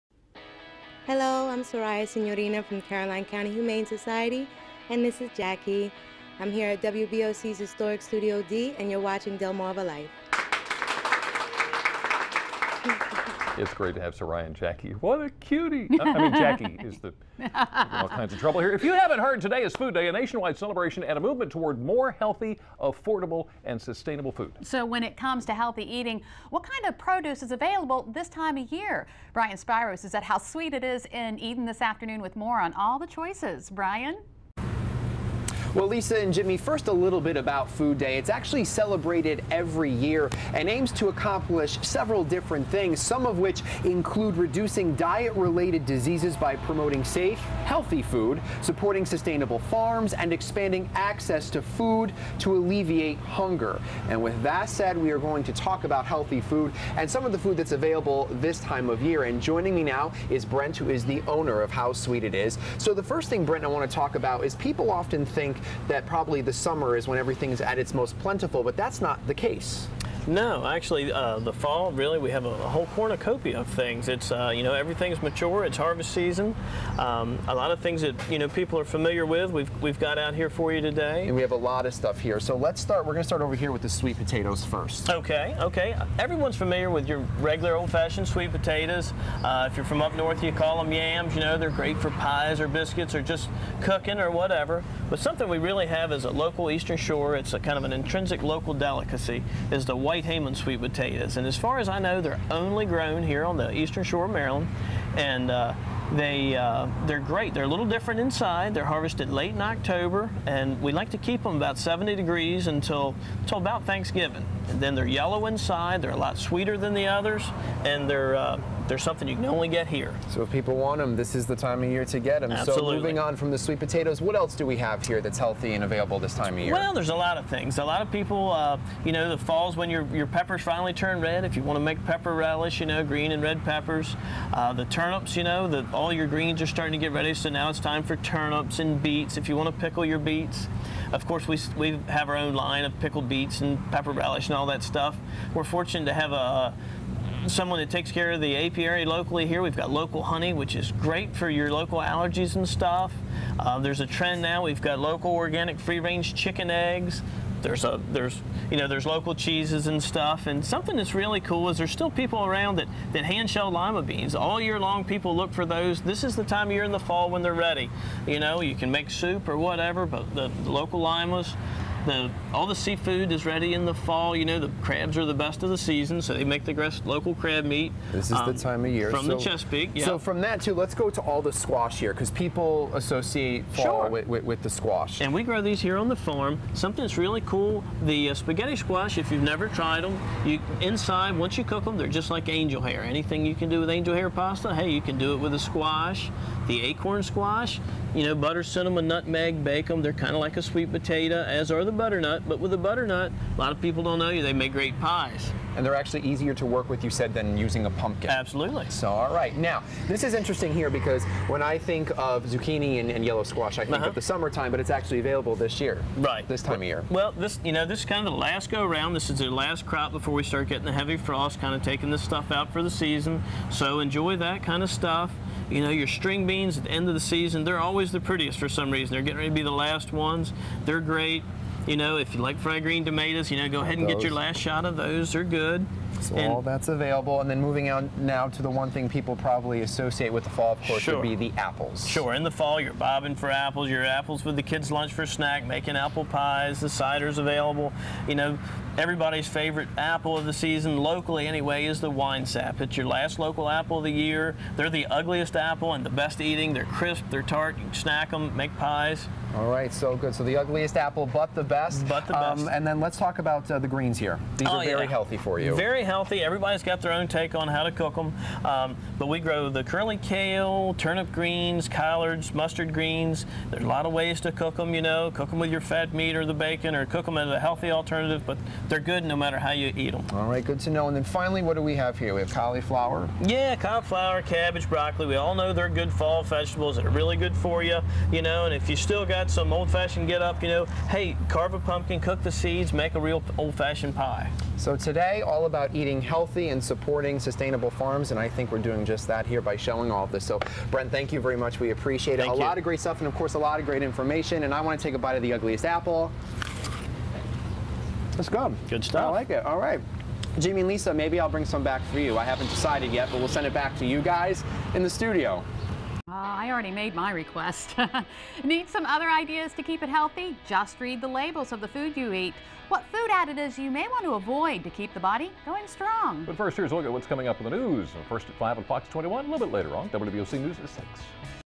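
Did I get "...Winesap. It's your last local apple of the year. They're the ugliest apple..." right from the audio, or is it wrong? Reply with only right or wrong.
right.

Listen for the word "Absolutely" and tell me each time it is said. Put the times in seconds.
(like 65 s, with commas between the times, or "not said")
122 s, 208 s.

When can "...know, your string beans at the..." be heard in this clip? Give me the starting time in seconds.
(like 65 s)
225 s.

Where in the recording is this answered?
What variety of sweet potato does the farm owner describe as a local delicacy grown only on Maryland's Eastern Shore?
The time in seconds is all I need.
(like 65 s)
100 s.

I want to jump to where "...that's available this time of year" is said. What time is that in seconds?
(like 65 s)
57 s.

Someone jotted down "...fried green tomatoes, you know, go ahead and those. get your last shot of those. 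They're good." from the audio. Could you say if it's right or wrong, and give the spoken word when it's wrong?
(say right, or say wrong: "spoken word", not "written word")
right.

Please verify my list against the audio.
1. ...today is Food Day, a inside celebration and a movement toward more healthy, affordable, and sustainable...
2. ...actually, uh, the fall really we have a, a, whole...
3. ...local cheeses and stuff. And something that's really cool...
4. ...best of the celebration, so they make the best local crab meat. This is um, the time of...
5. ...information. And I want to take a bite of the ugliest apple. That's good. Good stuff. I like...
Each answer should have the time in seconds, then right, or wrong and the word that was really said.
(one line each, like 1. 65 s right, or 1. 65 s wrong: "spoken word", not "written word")
1. 19 s wrong: "nationwide", not "inside"
2. 70 s right
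3. 159 s right
4. 175 s wrong: "season", not "celebration"
5. 304 s right.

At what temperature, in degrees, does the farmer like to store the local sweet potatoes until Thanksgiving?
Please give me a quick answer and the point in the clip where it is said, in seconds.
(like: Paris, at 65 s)
70, at 111 s.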